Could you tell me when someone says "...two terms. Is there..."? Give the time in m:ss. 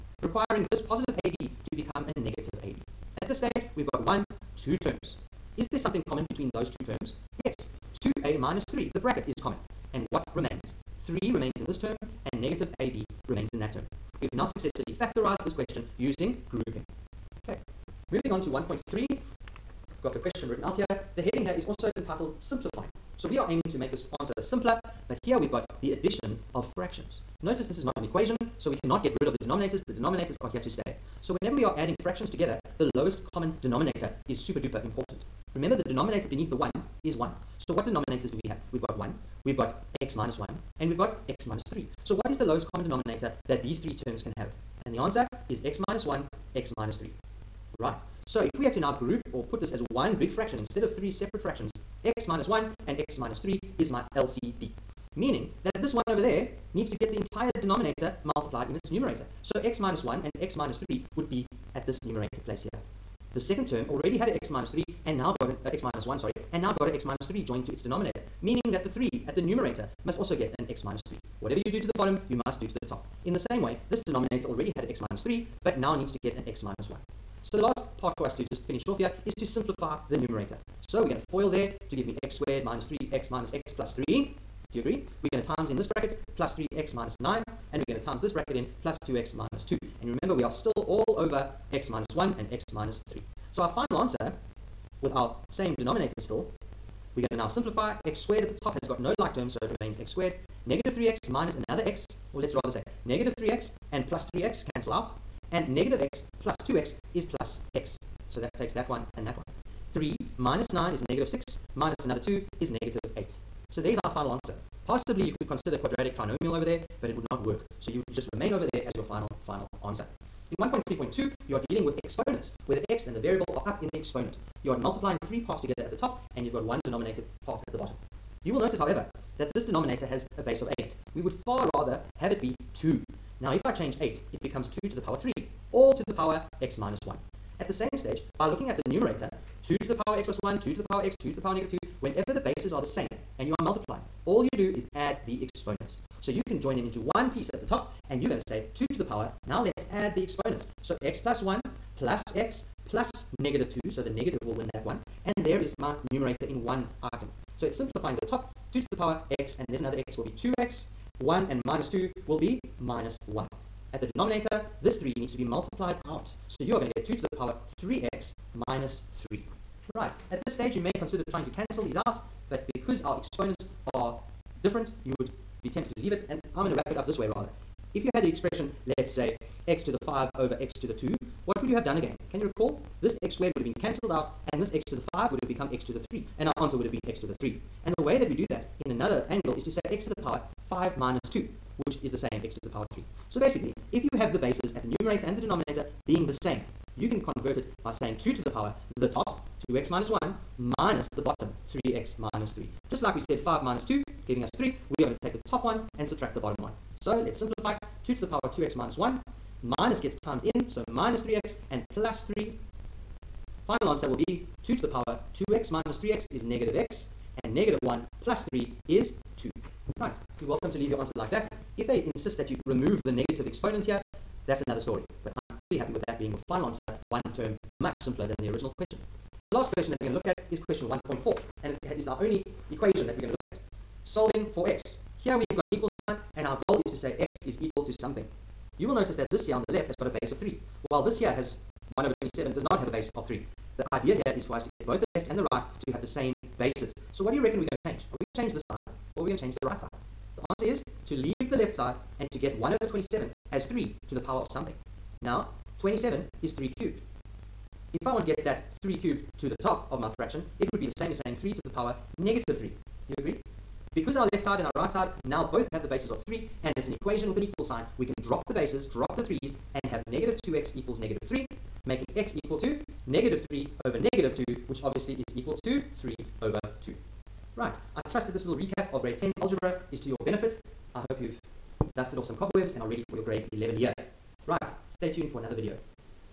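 0:04.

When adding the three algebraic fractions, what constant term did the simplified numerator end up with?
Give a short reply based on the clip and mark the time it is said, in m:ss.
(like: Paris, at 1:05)
-8, at 1:52.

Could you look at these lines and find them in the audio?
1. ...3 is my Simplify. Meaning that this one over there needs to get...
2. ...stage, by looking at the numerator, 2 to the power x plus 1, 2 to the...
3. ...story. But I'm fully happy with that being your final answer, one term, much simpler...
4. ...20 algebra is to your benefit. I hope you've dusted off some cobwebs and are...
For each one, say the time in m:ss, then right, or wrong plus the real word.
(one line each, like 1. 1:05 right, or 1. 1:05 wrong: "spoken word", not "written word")
1. 0:53 wrong: "LCD", not "Simplify"
2. 2:17 right
3. 3:44 right
4. 4:39 wrong: "10", not "20".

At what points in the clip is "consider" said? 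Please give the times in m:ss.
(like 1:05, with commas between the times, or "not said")
1:55, 2:50.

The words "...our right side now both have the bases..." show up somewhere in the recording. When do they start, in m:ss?
4:24.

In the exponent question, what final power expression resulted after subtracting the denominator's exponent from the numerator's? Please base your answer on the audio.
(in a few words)
2 to the power -x + 2.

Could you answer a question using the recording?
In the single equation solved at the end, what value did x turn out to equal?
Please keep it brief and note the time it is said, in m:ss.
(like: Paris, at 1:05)
3/2, at 4:36.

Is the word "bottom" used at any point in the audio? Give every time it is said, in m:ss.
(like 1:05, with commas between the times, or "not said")
1:11, 2:07, 3:21, 3:26.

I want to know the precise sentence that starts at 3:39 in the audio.
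Right, you're welcome to leave your answer like that.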